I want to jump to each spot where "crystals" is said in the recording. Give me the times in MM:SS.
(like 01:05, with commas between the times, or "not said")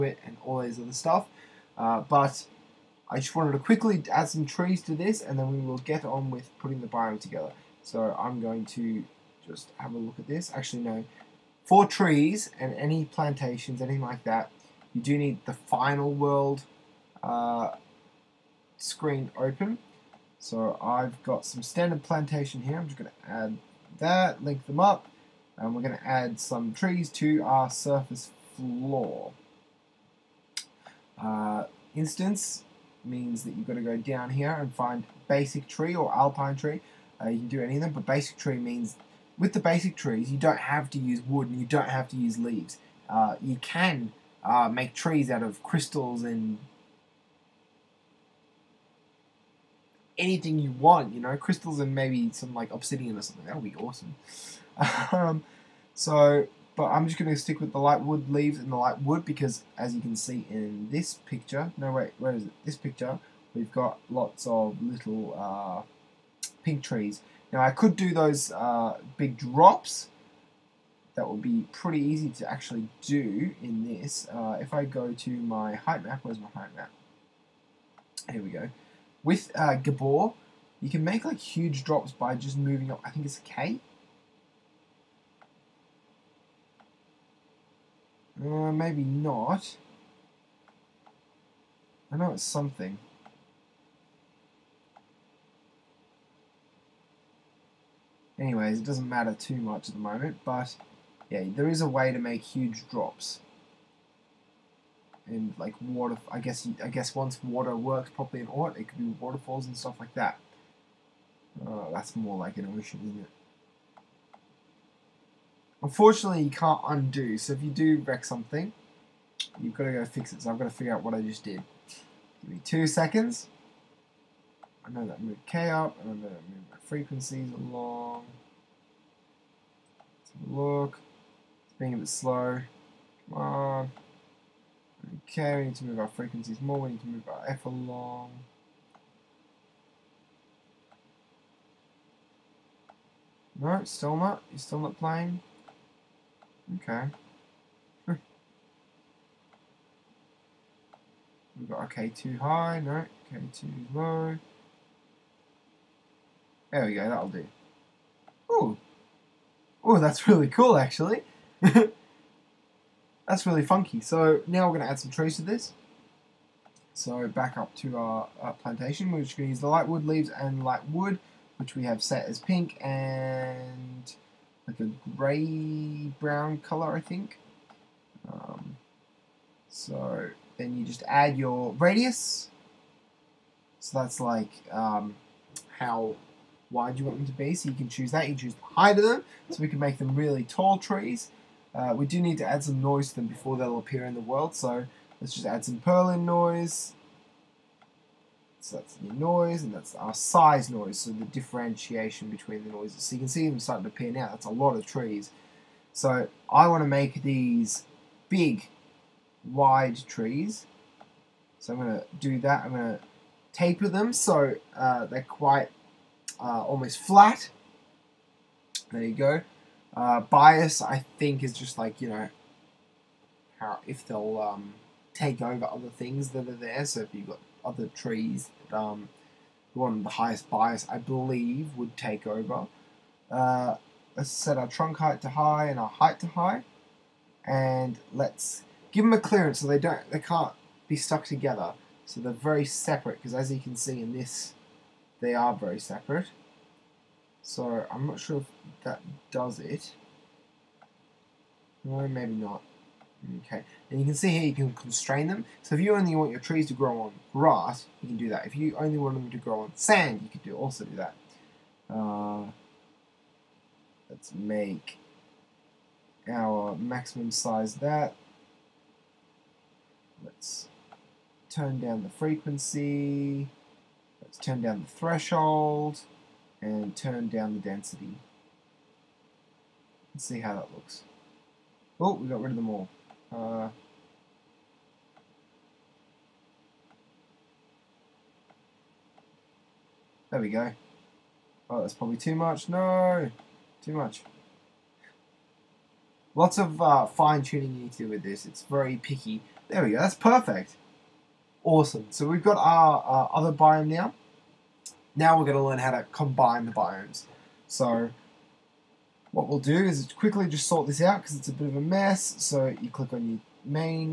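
00:45, 00:51.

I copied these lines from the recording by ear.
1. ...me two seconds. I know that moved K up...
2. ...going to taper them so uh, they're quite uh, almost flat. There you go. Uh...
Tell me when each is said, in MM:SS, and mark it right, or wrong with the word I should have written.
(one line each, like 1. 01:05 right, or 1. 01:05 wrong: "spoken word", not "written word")
1. 02:02 right
2. 03:32 right.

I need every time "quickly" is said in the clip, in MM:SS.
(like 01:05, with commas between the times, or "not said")
00:03, 05:10.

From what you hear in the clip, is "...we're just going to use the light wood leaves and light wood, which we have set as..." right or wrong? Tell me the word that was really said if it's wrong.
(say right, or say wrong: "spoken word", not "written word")
right.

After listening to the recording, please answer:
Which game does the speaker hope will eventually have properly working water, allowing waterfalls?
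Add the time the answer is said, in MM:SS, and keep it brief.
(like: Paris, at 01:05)
Oort, at 01:48.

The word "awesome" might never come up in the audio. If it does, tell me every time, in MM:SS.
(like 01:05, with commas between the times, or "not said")
00:53, 05:01.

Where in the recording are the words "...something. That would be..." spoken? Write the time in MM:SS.
00:53.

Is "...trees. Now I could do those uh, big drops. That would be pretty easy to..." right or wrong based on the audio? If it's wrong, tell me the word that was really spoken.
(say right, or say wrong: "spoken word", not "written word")
right.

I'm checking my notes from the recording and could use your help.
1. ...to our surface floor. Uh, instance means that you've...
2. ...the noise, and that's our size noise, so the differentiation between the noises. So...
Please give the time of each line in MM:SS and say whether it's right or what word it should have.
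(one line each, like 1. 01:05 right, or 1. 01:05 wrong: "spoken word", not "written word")
1. 00:27 right
2. 03:18 right.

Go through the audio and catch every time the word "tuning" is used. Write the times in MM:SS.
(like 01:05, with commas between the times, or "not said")
04:57.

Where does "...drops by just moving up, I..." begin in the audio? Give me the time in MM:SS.
01:21.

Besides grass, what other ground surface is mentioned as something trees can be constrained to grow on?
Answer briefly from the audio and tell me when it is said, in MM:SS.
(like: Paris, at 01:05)
Sand, at 04:19.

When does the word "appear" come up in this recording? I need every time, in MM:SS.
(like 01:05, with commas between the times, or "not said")
03:13, 03:23.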